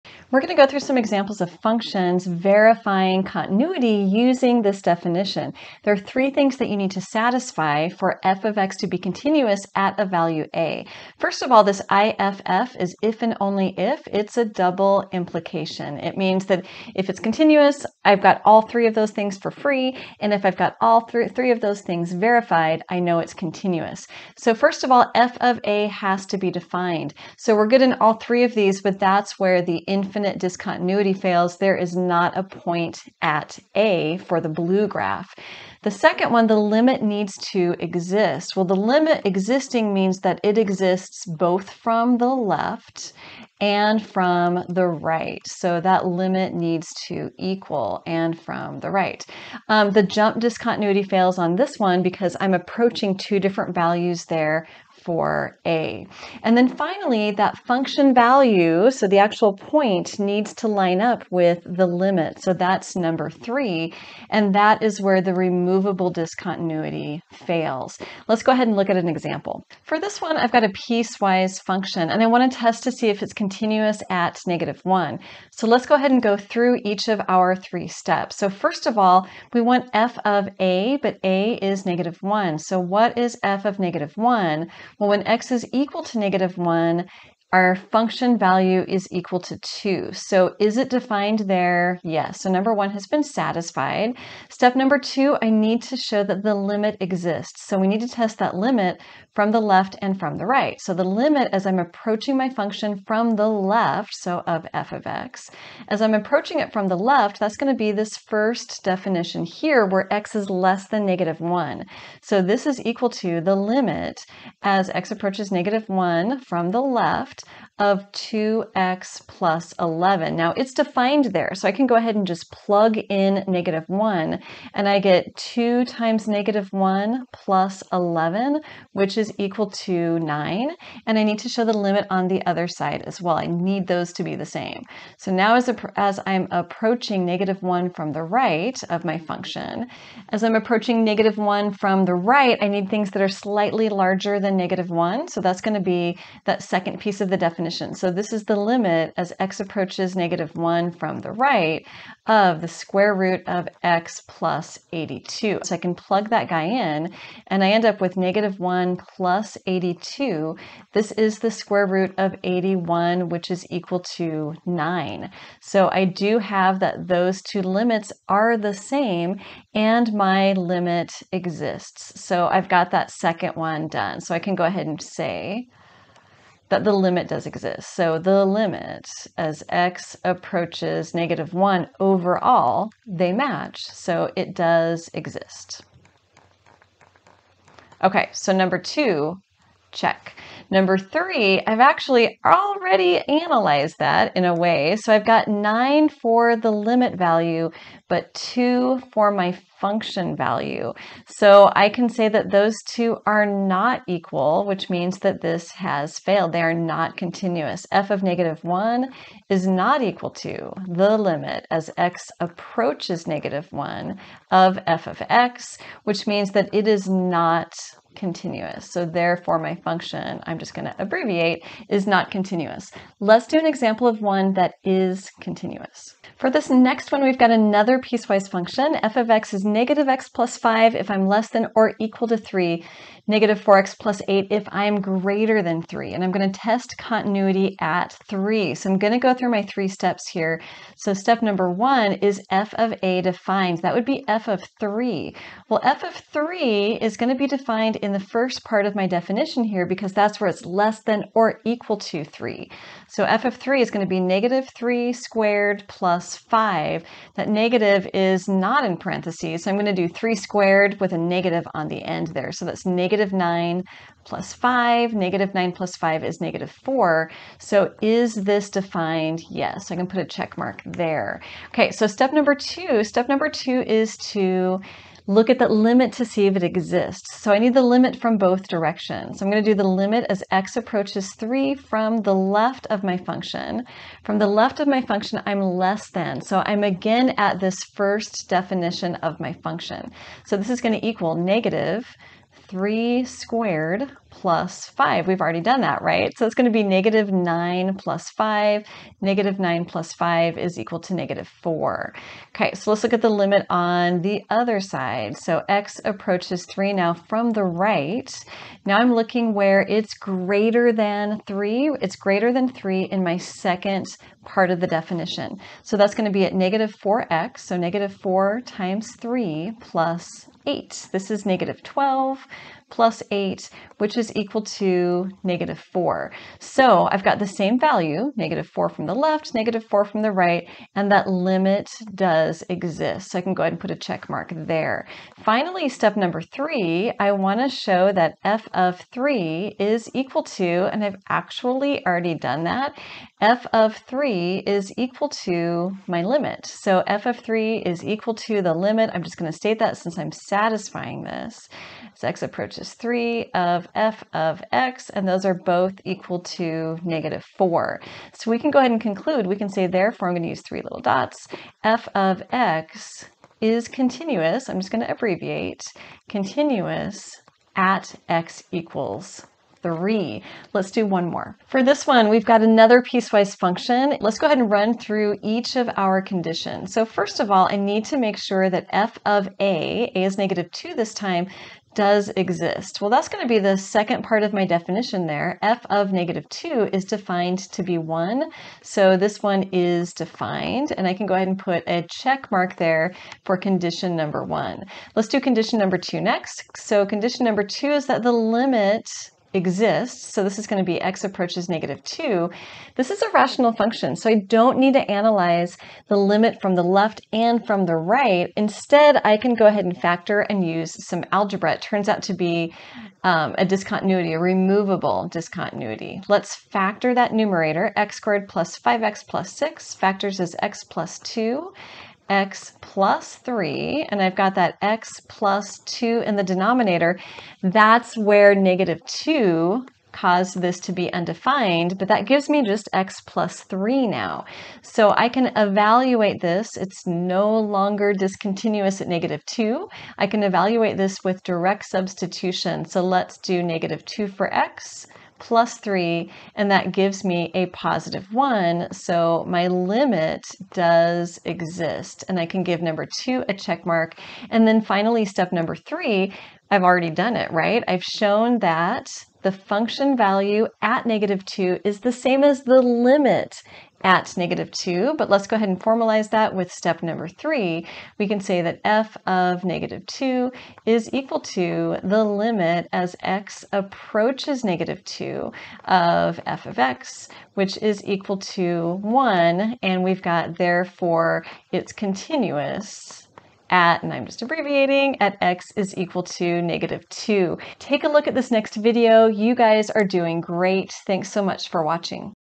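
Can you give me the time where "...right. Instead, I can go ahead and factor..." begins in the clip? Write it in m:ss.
6:47.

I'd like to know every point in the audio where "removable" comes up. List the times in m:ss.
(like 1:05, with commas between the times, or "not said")
1:05, 6:54.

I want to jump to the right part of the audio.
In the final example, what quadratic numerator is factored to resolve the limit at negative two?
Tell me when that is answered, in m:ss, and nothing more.
6:57.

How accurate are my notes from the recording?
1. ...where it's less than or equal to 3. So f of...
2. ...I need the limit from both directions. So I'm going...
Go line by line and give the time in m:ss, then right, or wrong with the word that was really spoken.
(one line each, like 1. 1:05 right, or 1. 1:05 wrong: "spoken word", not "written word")
1. 4:10 right
2. 4:37 right.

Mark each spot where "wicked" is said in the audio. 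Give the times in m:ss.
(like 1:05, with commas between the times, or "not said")
not said.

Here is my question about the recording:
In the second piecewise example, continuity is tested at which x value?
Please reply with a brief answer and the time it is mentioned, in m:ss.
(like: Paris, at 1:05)
3, at 3:56.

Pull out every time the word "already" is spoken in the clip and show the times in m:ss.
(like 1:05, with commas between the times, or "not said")
3:12, 4:55, 5:42, 7:36.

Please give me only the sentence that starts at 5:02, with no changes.
Okay, so let's look at the limit on the other side.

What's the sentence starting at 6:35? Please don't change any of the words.
Let's do condition number 2 next.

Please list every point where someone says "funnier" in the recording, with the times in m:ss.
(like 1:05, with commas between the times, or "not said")
not said.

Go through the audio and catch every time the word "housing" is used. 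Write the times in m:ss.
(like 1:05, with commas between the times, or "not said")
not said.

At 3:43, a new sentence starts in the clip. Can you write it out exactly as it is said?
Let's do an example of one that is continuous.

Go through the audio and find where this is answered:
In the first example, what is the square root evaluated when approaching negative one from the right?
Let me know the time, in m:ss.
2:41.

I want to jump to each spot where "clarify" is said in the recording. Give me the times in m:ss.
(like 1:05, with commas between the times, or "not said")
not said.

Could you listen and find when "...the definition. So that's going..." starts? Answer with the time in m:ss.
5:14.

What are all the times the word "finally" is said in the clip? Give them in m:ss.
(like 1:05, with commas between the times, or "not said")
0:56, 5:35, 7:34.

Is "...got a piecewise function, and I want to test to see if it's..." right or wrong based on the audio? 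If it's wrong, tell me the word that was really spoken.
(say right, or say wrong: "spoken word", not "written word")
right.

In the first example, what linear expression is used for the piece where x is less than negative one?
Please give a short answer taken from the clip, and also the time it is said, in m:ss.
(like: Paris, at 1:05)
2x + 11, at 1:58.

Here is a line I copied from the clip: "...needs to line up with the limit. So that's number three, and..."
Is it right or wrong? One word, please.
right.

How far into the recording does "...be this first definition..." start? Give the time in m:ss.
1:47.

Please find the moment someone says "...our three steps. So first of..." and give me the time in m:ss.
1:17.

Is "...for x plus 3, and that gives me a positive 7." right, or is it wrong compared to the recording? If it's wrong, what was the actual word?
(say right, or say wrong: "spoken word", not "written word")
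wrong: "1", not "7".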